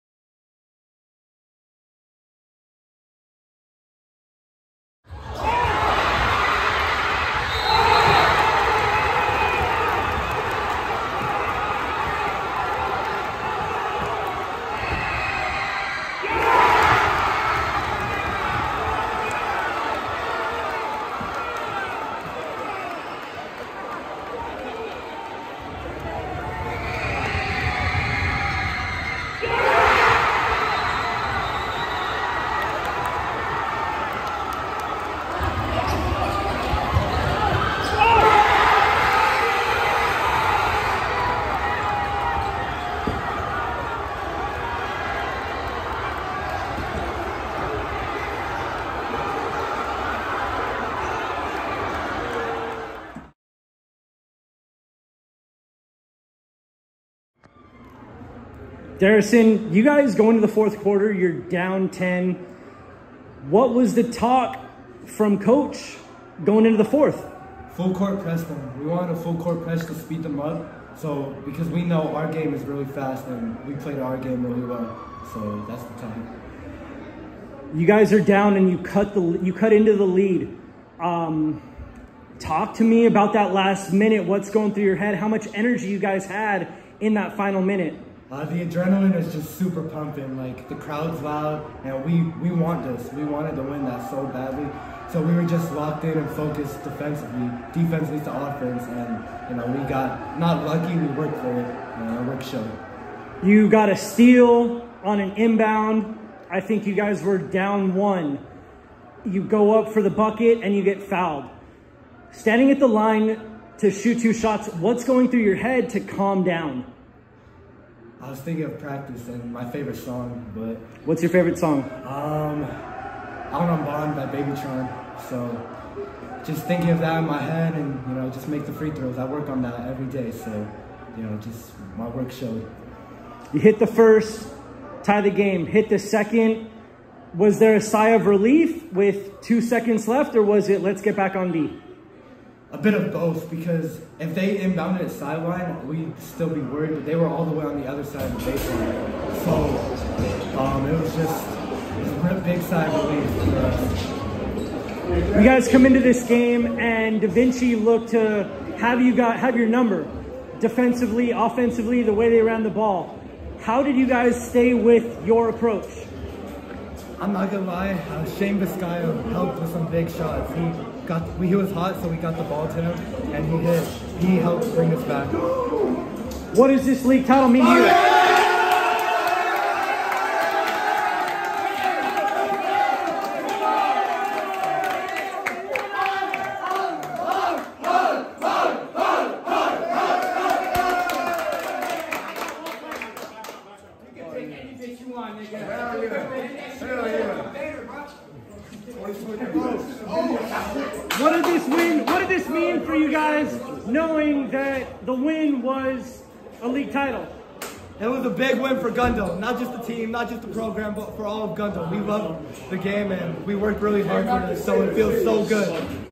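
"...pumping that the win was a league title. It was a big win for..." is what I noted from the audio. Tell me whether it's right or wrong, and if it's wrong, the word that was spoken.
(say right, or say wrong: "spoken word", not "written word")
wrong: "knowing", not "pumping".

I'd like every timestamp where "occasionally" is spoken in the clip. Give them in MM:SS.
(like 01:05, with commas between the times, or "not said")
not said.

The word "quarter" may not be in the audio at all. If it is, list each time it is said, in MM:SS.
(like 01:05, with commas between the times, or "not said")
01:00.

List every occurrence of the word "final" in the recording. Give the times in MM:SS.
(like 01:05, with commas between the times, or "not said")
01:27.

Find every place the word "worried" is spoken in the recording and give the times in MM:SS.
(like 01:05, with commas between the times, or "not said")
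02:26.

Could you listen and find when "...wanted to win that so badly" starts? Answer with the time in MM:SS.
01:33.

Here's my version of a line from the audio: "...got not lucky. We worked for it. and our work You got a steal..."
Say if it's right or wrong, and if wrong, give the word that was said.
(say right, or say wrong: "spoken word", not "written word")
right.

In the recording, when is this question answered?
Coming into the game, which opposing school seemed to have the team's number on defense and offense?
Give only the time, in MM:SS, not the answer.
02:37.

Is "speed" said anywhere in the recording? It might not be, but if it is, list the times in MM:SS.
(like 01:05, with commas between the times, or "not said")
01:09.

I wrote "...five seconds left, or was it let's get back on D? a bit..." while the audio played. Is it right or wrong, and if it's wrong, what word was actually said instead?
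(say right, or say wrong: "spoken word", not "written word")
wrong: "two", not "five".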